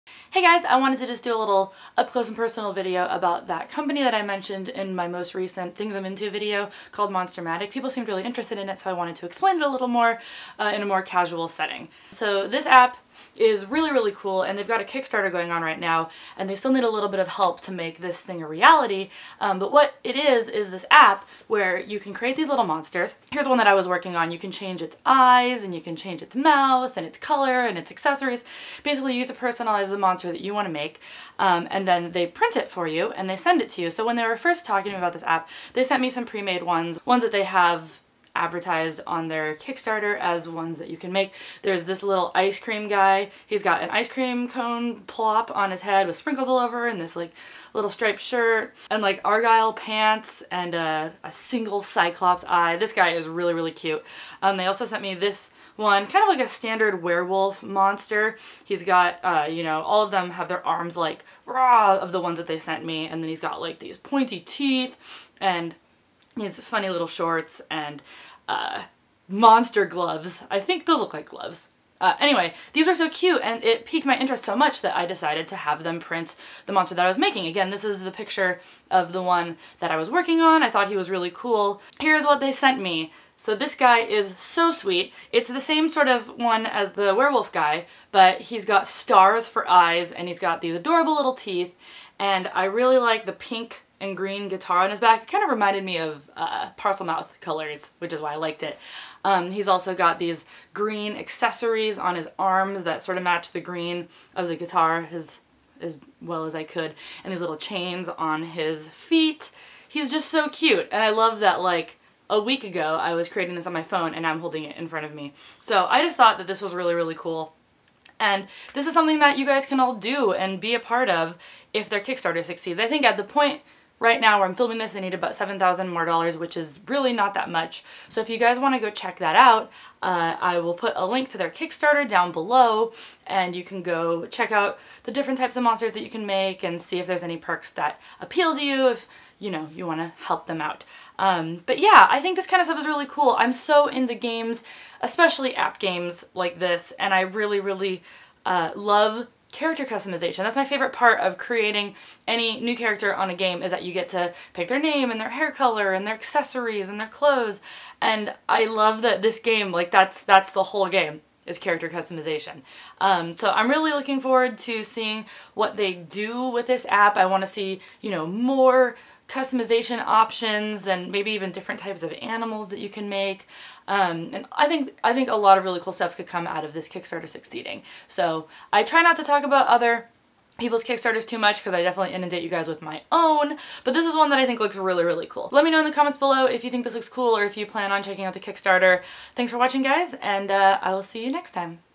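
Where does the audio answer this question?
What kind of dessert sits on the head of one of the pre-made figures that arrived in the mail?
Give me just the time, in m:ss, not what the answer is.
0:43.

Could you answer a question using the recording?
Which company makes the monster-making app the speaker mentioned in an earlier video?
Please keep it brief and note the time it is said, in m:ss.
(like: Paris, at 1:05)
Monstermatic, at 0:07.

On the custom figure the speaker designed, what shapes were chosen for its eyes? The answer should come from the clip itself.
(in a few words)
Stars.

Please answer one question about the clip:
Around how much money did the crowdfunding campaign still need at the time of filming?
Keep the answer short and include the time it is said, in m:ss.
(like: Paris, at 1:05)
$7,000, at 2:05.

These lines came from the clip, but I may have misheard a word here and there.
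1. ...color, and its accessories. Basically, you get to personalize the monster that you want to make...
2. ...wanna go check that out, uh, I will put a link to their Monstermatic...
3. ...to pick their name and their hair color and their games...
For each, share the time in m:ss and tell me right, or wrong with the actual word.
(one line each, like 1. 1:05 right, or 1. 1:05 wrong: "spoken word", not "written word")
1. 0:27 right
2. 2:08 wrong: "Kickstarter", not "Monstermatic"
3. 2:34 wrong: "accessories", not "games".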